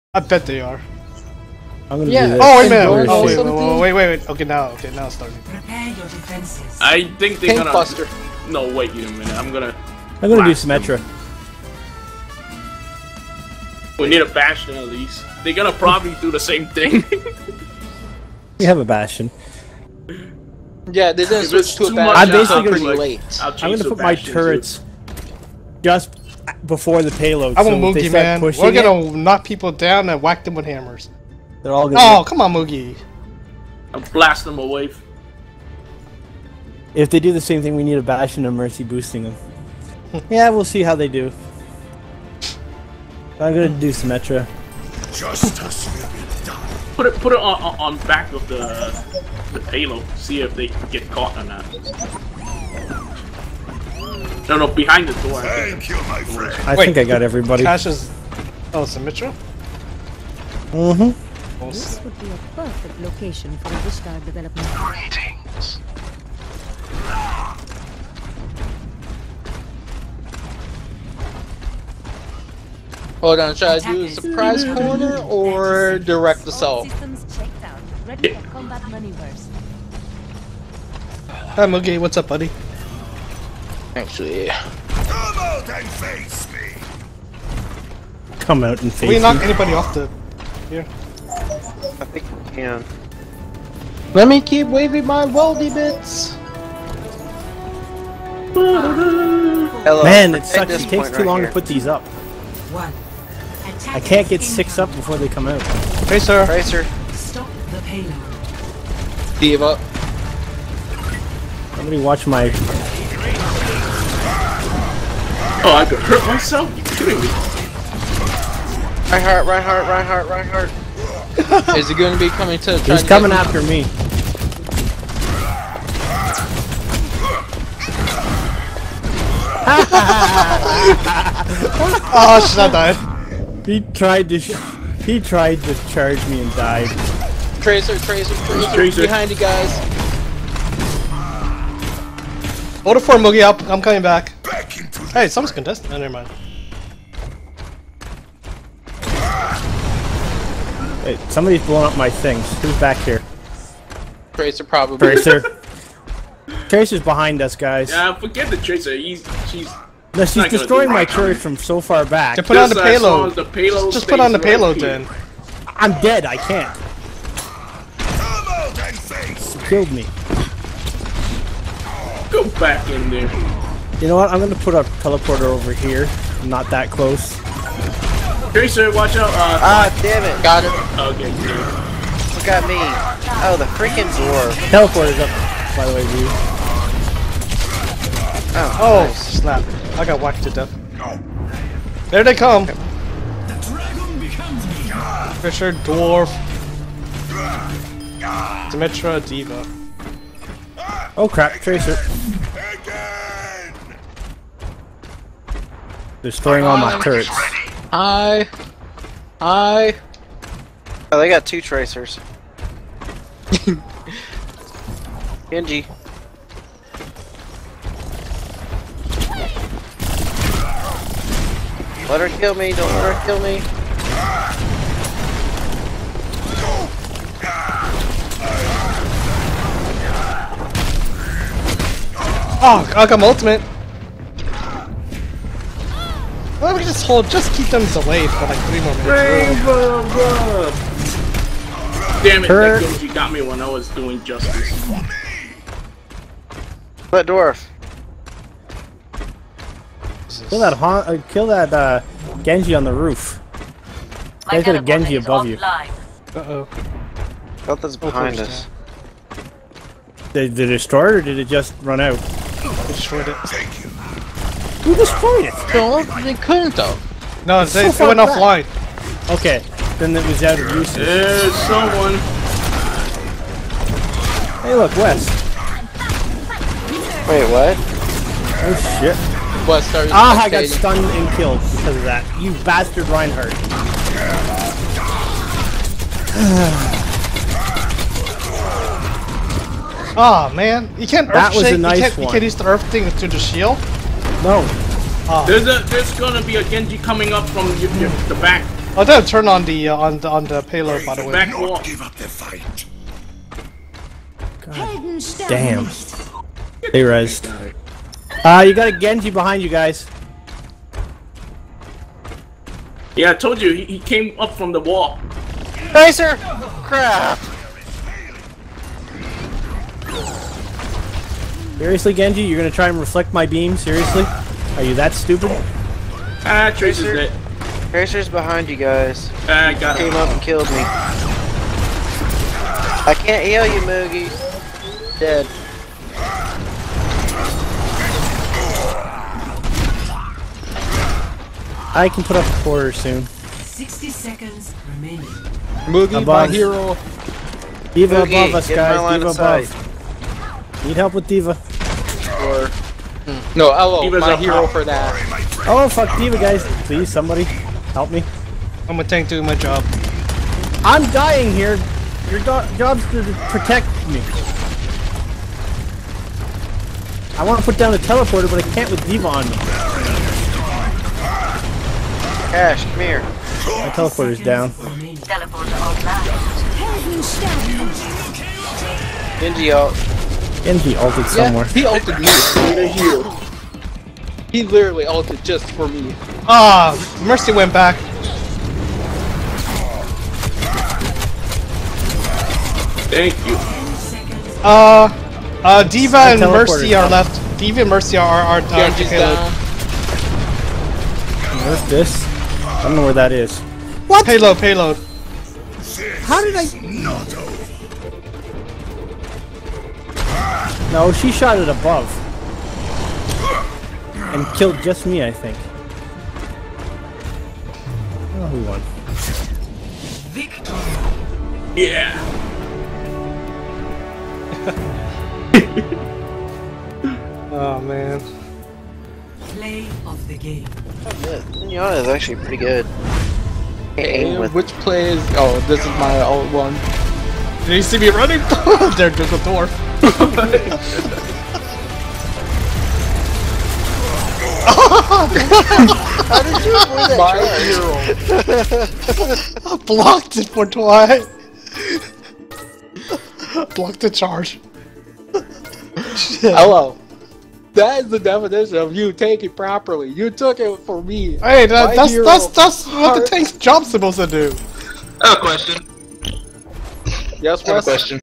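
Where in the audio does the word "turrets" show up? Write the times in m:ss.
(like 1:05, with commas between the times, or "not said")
0:24, 2:41, 3:27.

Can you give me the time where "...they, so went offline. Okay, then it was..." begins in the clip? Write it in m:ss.
4:27.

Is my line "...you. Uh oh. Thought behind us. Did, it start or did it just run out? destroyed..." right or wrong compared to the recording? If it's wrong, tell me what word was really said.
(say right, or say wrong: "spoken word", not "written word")
right.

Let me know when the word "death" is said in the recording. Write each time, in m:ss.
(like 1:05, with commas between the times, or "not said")
3:10.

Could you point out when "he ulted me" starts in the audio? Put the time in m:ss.
6:21.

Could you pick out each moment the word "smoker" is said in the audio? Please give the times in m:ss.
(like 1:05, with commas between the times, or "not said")
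not said.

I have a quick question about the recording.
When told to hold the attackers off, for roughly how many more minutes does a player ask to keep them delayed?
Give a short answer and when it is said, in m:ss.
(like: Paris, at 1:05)
3, at 3:58.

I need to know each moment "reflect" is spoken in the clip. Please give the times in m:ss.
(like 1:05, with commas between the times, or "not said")
5:22.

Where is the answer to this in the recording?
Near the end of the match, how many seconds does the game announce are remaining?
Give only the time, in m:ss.
5:43.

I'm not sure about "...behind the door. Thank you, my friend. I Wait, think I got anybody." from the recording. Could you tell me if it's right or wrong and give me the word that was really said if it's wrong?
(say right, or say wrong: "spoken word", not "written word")
wrong: "everybody", not "anybody".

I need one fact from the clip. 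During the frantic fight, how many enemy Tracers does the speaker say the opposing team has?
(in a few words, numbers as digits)
2.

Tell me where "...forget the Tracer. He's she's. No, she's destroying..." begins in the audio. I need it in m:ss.
2:38.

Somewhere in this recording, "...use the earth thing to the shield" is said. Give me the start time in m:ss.
4:52.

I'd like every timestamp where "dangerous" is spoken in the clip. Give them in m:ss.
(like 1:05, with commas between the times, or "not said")
not said.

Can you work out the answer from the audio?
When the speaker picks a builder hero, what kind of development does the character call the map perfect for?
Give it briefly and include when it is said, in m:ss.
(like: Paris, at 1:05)
Vishkar development, at 1:03.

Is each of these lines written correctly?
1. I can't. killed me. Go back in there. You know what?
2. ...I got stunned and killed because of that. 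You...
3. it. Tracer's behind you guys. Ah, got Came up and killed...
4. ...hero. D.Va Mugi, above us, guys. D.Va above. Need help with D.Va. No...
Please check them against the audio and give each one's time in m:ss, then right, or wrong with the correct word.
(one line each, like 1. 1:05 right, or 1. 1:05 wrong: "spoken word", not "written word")
1. 2:46 right
2. 4:40 right
3. 5:27 right
4. 5:46 right.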